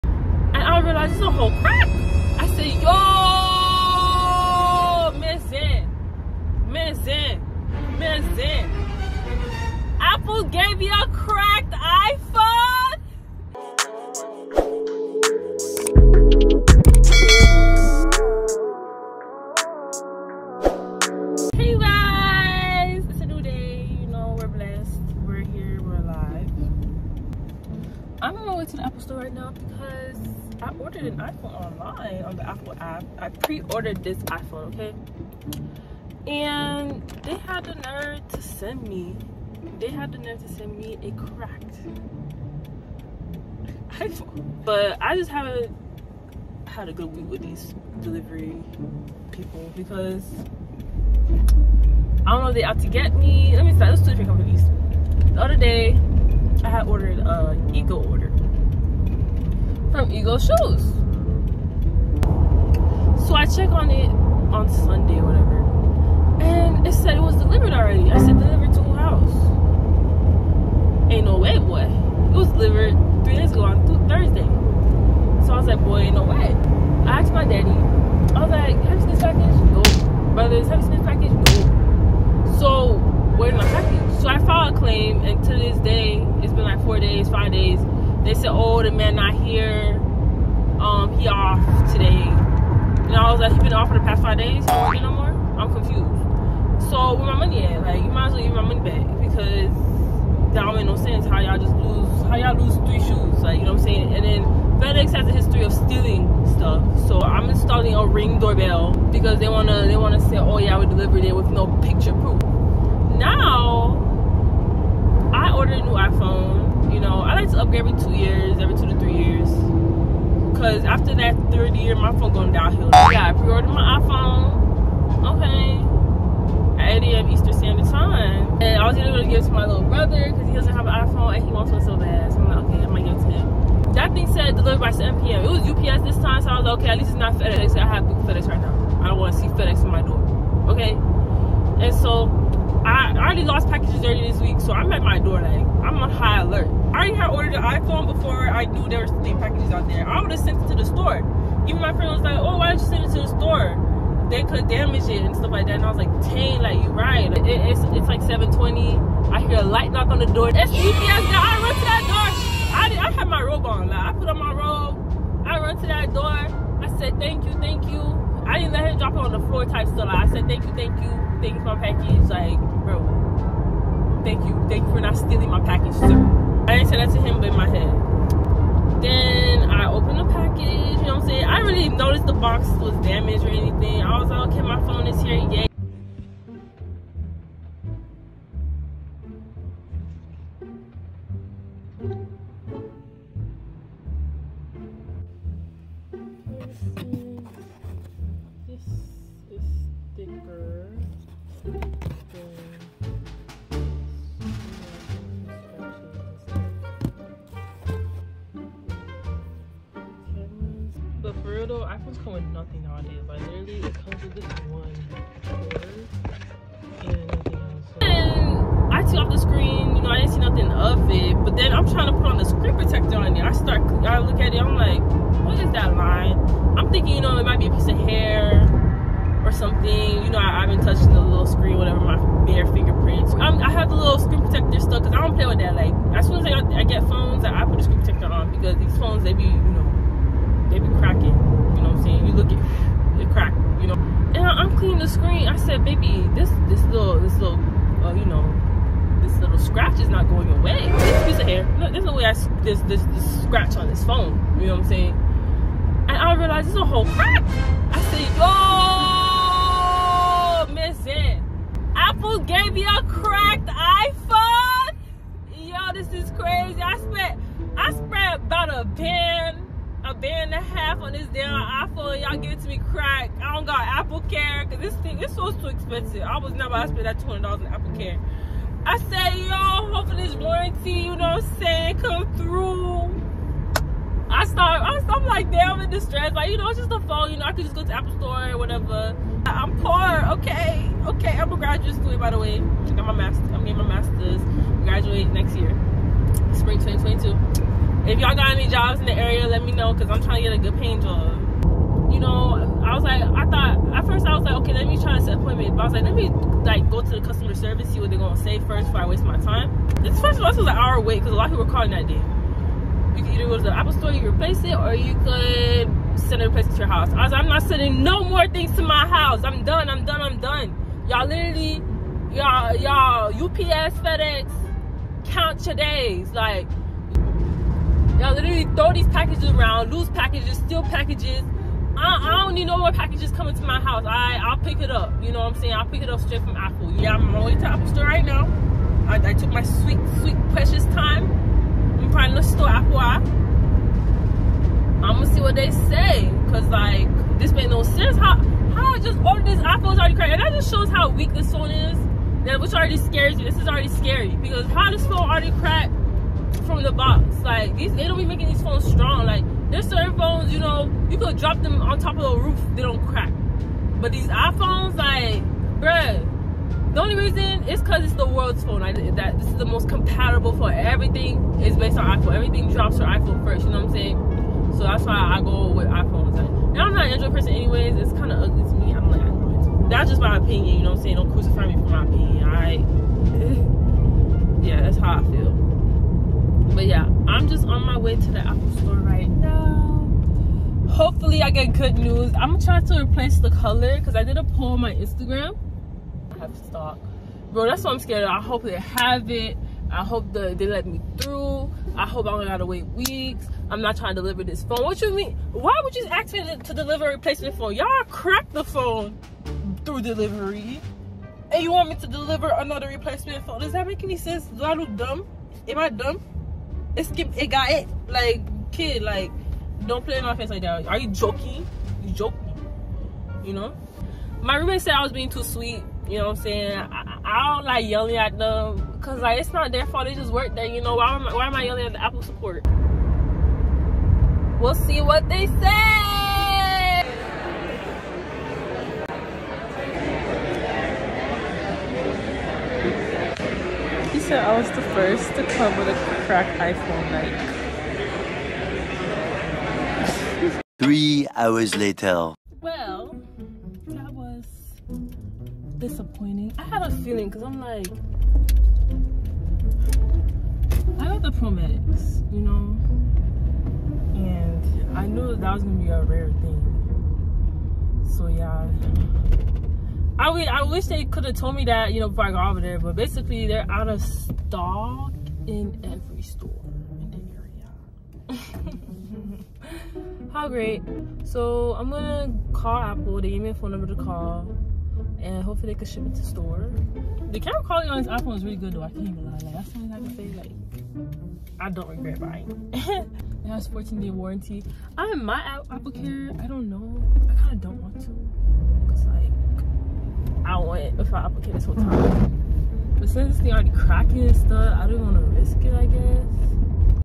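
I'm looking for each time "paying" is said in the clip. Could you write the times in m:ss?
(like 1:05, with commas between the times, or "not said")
5:00.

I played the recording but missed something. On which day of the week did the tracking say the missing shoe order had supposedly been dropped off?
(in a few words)
Thursday.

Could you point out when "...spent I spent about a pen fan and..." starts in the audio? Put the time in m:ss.
4:26.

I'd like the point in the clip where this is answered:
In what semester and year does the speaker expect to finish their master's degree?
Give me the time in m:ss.
4:56.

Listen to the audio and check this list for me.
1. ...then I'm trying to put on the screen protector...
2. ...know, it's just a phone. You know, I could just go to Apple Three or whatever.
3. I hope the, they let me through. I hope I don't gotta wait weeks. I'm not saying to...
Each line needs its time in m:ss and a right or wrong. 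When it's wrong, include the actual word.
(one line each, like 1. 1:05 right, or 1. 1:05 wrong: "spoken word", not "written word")
1. 3:41 right
2. 4:46 wrong: "Store", not "Three"
3. 6:39 wrong: "trying", not "saying".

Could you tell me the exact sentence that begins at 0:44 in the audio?
But I just haven't had a good week with these delivery people because I don't know if they out to get me.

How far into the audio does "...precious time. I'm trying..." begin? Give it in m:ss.
5:40.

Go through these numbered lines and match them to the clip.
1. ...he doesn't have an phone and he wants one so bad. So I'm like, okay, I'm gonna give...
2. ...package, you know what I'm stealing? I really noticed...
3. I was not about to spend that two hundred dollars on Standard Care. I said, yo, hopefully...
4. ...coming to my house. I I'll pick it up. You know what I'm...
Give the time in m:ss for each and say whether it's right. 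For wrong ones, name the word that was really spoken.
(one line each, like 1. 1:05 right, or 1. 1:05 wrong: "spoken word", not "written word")
1. 2:10 wrong: "iPhone", not "phone"
2. 3:00 wrong: "saying", not "stealing"
3. 4:36 wrong: "Apple", not "Standard"
4. 5:33 right.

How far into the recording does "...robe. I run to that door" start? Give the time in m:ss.
2:44.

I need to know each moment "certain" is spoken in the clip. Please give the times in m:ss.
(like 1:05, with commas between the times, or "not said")
5:59.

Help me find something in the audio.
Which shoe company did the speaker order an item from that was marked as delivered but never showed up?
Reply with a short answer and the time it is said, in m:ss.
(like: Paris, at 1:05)
Ego Shoes, at 1:00.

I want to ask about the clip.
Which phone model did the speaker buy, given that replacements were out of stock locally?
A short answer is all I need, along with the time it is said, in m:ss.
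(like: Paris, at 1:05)
Pro Max, at 7:41.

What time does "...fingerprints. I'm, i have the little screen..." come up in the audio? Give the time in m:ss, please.
3:52.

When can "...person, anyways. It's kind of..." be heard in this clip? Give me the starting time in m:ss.
6:17.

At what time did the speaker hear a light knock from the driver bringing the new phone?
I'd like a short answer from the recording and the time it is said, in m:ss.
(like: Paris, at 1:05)
7:20, at 2:38.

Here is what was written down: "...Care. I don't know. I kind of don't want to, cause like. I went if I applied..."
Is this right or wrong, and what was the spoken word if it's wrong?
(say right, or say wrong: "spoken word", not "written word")
right.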